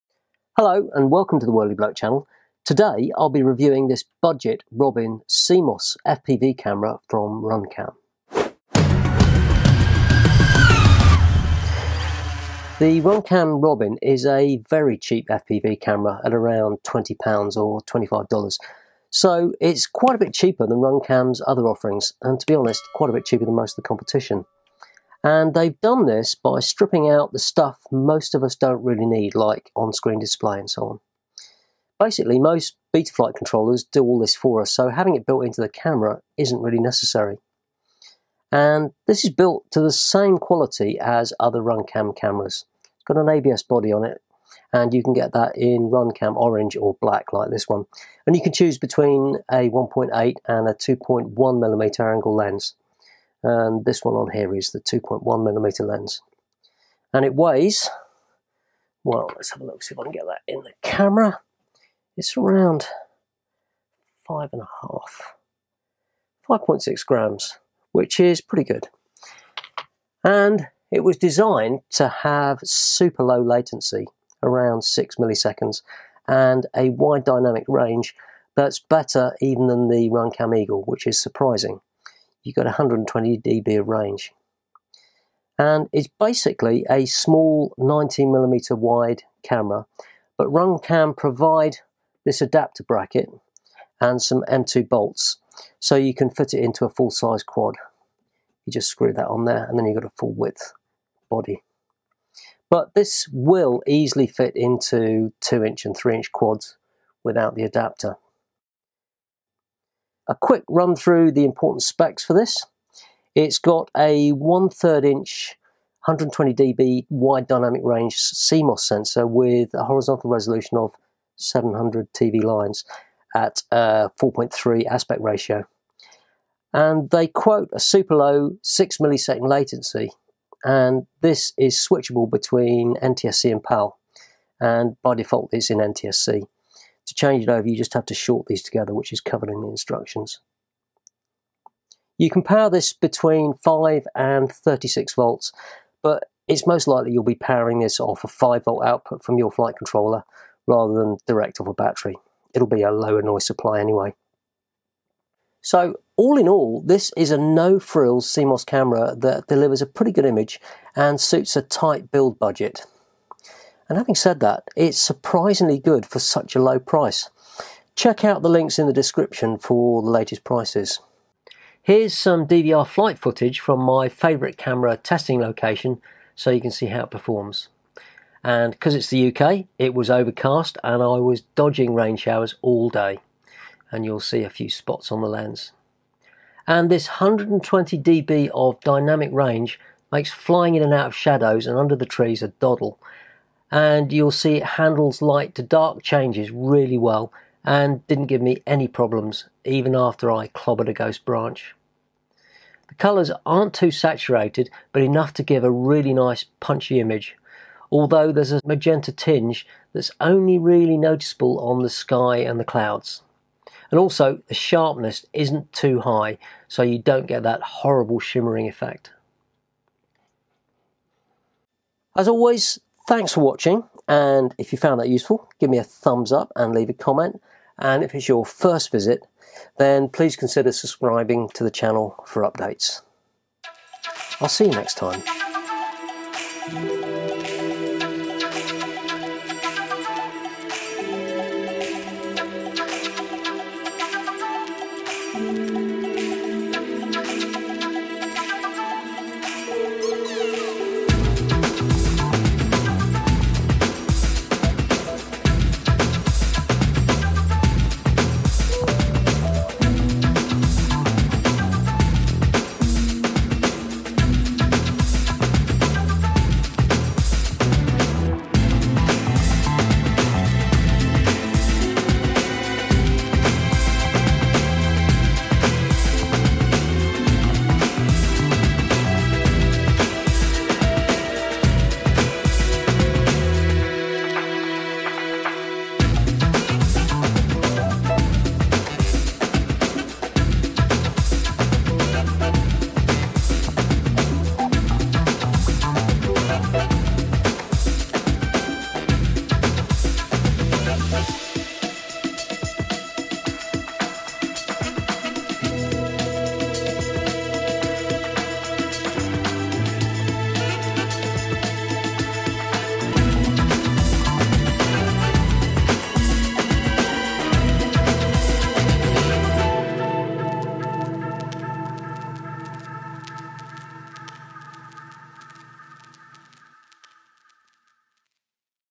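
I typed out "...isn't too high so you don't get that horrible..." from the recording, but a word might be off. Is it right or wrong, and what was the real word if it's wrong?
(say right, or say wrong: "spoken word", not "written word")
right.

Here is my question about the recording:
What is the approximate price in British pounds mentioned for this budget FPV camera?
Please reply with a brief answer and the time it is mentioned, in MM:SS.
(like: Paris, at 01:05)
£20, at 00:16.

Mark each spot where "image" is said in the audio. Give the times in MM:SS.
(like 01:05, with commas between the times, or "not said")
02:40, 03:26.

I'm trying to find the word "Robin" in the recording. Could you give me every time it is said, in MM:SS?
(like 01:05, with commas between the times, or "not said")
00:04, 00:13.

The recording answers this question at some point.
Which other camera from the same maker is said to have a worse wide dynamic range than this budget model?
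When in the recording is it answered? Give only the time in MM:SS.
01:20.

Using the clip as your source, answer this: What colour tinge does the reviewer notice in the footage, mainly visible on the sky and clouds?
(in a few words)
magenta.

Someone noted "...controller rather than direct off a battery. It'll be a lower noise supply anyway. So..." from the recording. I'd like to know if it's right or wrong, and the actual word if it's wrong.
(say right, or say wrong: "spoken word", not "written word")
right.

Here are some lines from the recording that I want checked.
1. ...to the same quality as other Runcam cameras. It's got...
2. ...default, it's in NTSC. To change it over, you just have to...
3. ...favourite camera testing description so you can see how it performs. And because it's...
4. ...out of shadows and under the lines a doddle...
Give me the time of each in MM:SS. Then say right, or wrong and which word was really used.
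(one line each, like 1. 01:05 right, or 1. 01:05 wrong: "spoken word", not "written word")
1. 00:39 right
2. 02:15 right
3. 02:54 wrong: "location", not "description"
4. 03:10 wrong: "trees", not "lines".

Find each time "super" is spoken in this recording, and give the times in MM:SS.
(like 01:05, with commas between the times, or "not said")
01:12, 02:07.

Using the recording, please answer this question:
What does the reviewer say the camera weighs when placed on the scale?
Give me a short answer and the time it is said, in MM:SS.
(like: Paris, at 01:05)
5.6 grams, at 01:06.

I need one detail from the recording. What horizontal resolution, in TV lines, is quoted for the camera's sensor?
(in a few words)
700 TV lines.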